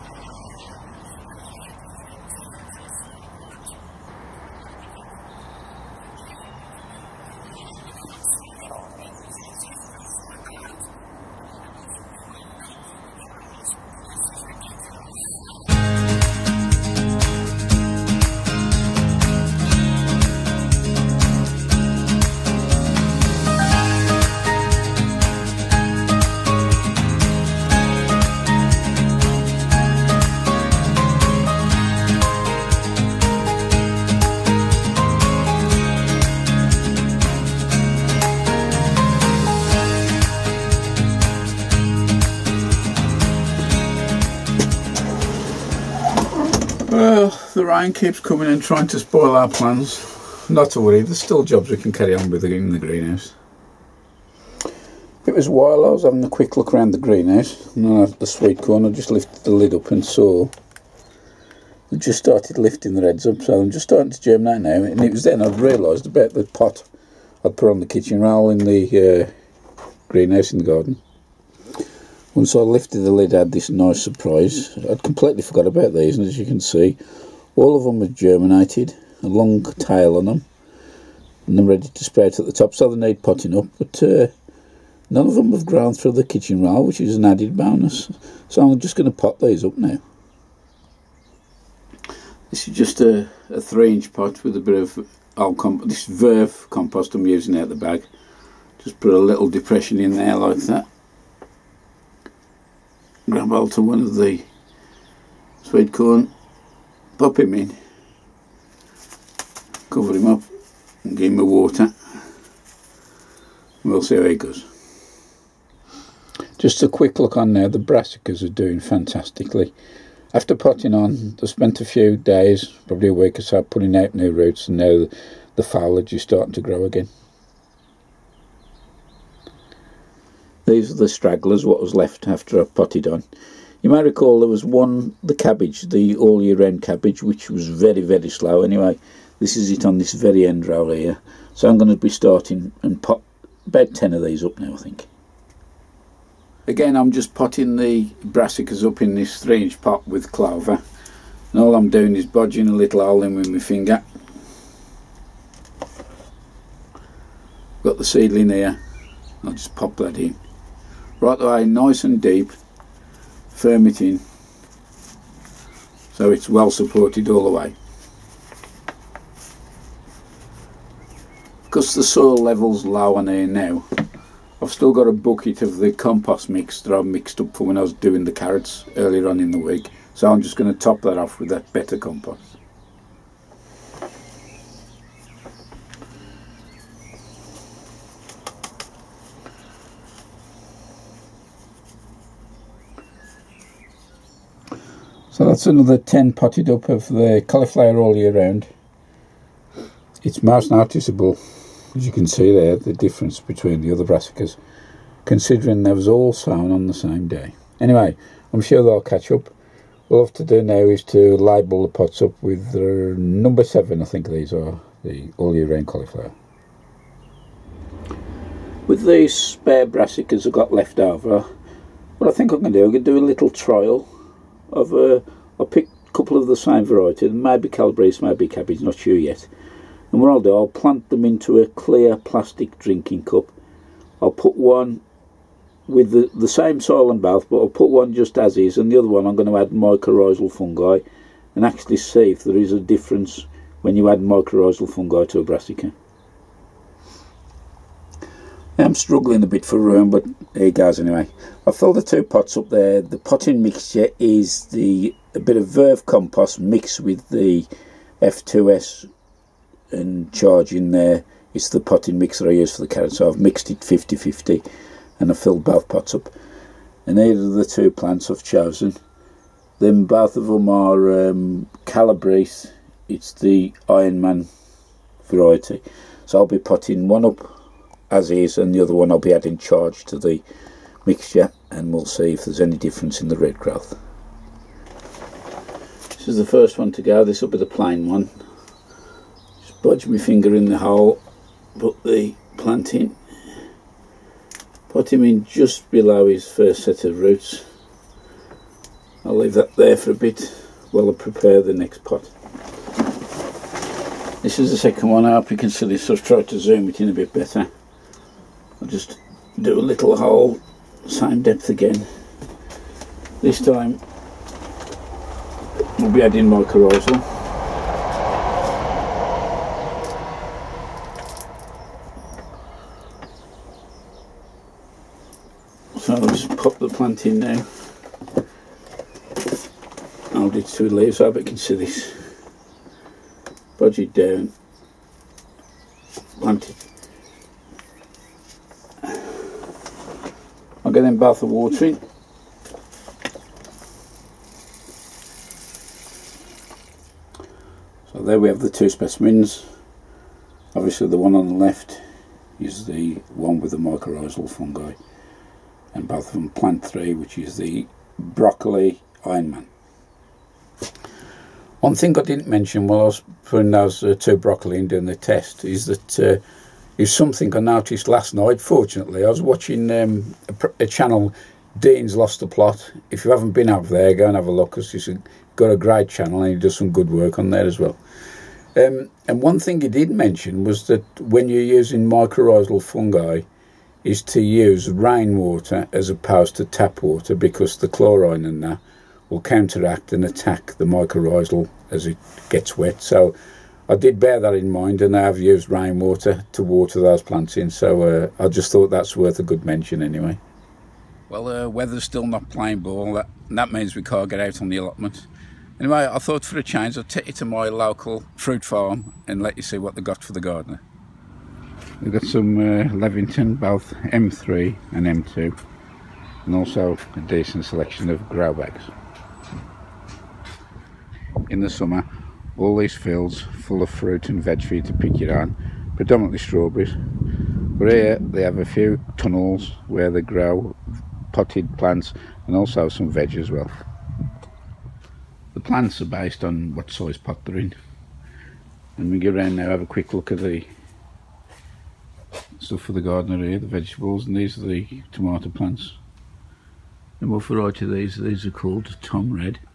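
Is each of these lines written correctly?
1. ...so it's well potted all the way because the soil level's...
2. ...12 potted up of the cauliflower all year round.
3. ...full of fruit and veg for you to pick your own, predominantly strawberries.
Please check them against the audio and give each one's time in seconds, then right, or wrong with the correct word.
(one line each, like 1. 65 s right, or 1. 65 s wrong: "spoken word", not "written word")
1. 166 s wrong: "supported", not "potted"
2. 195 s wrong: "10", not "12"
3. 423 s right.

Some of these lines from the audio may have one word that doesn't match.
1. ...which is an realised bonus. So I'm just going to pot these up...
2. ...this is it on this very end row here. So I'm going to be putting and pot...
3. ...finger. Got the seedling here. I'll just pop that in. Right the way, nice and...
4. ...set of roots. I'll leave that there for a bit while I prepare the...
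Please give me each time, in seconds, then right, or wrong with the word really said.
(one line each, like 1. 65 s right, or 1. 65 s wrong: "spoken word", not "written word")
1. 86 s wrong: "added", not "realised"
2. 139 s wrong: "starting", not "putting"
3. 153 s right
4. 296 s right.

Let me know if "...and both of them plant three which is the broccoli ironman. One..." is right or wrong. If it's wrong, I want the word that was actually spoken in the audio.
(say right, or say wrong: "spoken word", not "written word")
right.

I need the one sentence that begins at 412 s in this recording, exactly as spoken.
We've got some uh, Levington, both M3 and M2, and also a decent selection of grow bags.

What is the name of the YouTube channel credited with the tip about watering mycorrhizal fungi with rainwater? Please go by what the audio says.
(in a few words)
Dean's Lost the Plot.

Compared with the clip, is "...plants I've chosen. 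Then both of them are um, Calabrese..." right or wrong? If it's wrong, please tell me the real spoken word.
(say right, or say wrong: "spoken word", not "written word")
right.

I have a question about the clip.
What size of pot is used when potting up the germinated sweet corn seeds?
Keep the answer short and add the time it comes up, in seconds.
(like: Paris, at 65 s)
3 inch, at 93 s.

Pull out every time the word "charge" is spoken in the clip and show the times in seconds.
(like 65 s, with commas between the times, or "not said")
260 s, 279 s.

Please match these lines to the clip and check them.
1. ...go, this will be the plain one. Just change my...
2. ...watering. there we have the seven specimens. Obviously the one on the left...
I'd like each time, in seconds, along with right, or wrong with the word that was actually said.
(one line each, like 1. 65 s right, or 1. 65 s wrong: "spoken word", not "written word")
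1. 287 s wrong: "budge", not "change"
2. 341 s wrong: "two", not "seven".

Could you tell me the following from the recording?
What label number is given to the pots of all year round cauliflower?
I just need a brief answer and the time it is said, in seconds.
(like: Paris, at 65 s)
7, at 213 s.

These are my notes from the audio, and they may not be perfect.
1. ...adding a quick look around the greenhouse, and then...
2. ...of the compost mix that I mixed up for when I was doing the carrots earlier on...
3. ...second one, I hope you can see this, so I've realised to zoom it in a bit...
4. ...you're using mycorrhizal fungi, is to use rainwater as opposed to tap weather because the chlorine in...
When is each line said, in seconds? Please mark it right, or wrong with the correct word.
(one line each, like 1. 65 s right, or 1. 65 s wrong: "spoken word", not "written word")
1. 56 s wrong: "having", not "adding"
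2. 175 s right
3. 304 s wrong: "tried", not "realised"
4. 381 s wrong: "water", not "weather".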